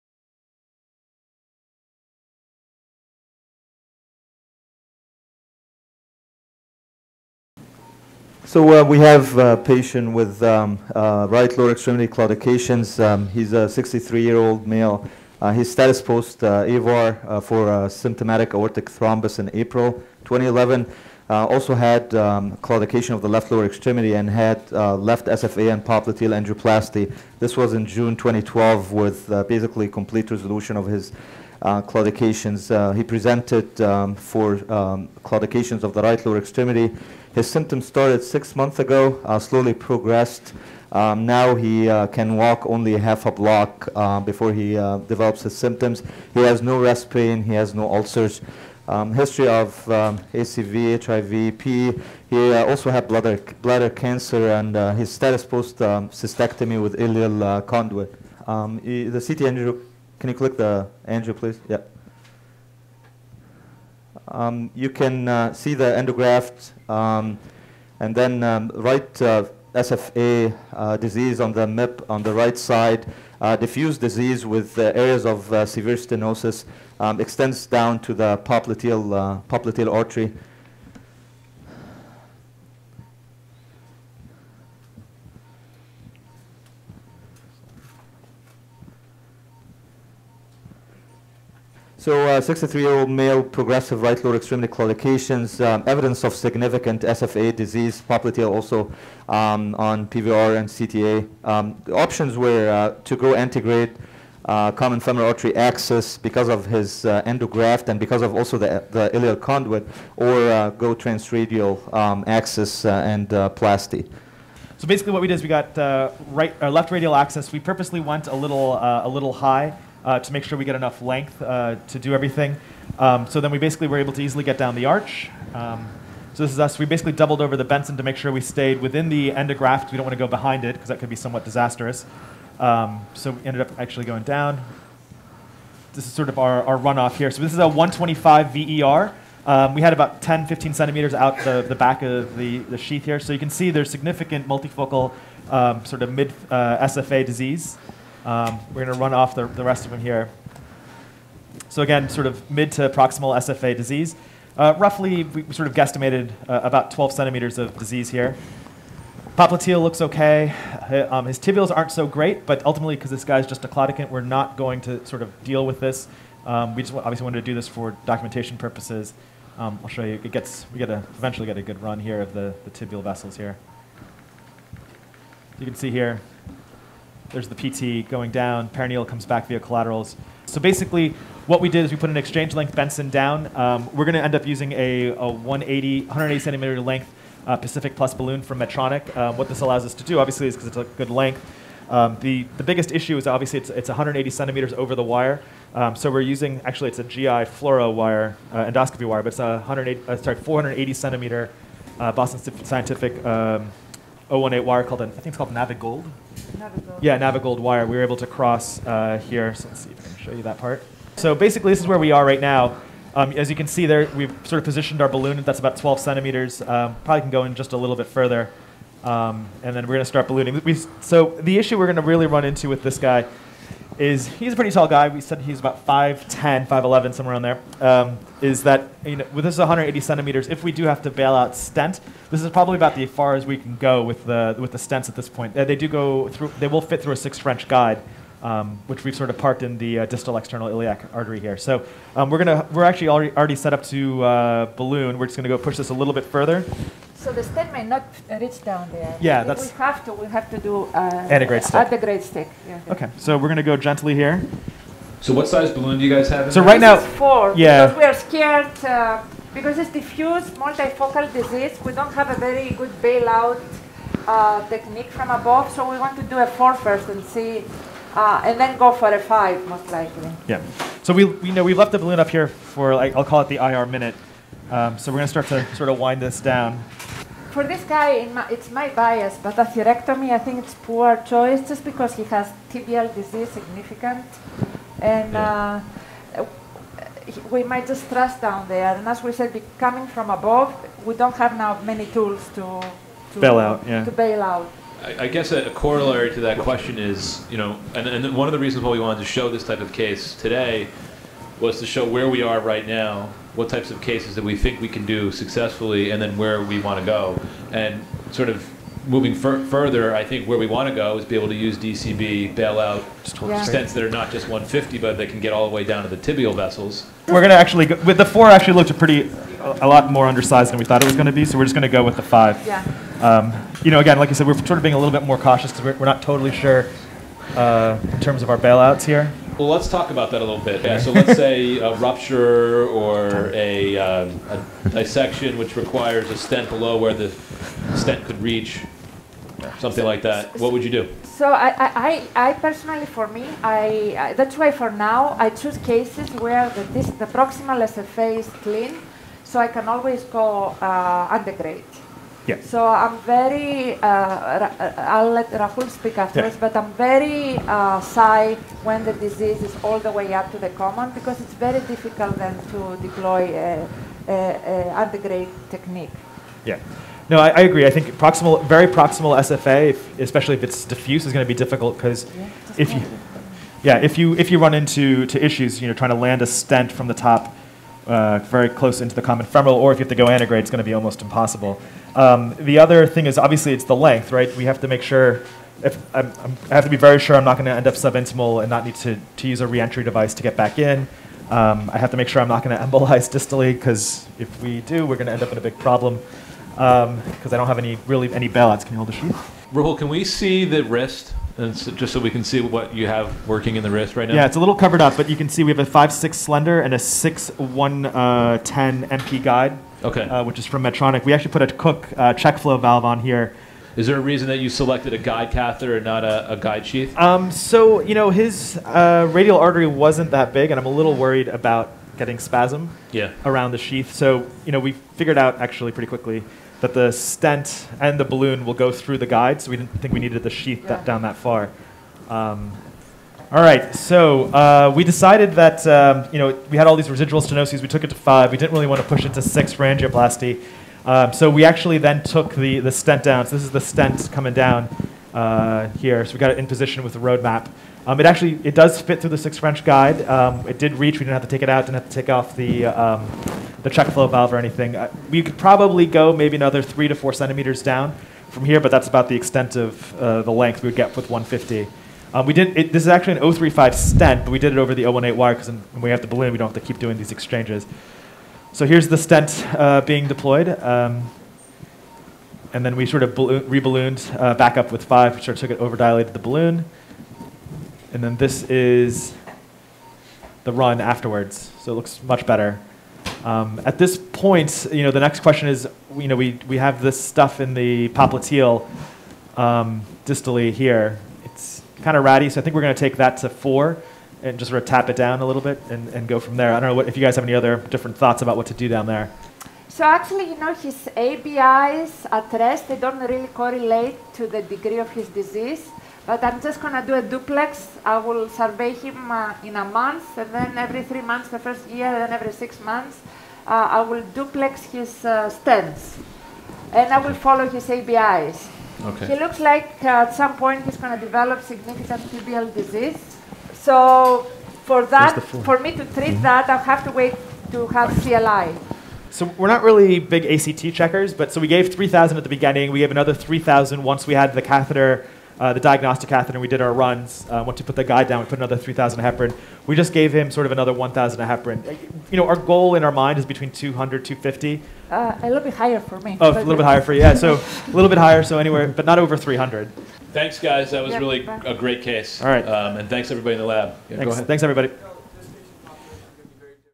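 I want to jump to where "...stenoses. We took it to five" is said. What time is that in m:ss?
7:17.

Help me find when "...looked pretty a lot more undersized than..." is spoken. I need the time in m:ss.
5:18.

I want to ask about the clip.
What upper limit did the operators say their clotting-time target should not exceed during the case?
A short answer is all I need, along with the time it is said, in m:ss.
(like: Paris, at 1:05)
300, at 9:09.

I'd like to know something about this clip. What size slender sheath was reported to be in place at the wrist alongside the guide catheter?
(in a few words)
5/6 slender.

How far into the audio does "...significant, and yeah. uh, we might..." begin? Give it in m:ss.
4:43.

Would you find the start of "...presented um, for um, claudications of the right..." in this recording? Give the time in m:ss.
0:33.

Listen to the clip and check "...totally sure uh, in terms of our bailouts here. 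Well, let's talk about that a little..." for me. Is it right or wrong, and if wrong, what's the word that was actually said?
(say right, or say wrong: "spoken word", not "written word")
right.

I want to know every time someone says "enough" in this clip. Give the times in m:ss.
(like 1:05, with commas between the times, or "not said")
2:00.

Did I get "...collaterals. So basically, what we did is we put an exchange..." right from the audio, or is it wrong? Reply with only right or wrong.
right.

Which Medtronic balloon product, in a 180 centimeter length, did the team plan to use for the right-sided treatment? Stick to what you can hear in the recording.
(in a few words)
Pacific Plus.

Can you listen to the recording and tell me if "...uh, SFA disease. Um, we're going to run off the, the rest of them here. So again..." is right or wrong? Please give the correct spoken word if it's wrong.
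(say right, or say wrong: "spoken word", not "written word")
right.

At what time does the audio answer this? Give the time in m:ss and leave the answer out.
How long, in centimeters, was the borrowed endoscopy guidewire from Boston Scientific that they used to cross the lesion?
3:20.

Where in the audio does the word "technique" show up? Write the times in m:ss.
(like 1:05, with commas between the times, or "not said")
4:24, 6:05.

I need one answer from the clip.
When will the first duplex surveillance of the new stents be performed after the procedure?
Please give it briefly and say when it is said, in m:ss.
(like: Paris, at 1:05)
in a month, at 8:29.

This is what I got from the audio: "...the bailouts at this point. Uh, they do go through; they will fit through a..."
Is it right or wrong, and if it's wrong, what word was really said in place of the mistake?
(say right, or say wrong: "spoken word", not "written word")
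wrong: "stents", not "bailouts".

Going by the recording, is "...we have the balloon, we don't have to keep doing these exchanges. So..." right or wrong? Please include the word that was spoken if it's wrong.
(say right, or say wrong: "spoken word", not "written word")
right.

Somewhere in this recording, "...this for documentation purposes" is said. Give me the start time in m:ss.
2:47.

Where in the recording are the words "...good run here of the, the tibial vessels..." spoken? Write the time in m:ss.
2:51.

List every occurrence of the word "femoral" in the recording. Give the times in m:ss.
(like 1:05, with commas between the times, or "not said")
1:44, 6:19.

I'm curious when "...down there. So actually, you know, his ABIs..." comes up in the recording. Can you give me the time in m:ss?
8:18.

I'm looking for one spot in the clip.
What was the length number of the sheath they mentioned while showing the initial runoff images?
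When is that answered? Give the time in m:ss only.
2:17.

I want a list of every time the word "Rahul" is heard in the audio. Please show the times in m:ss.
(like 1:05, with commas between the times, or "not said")
5:55, 6:39.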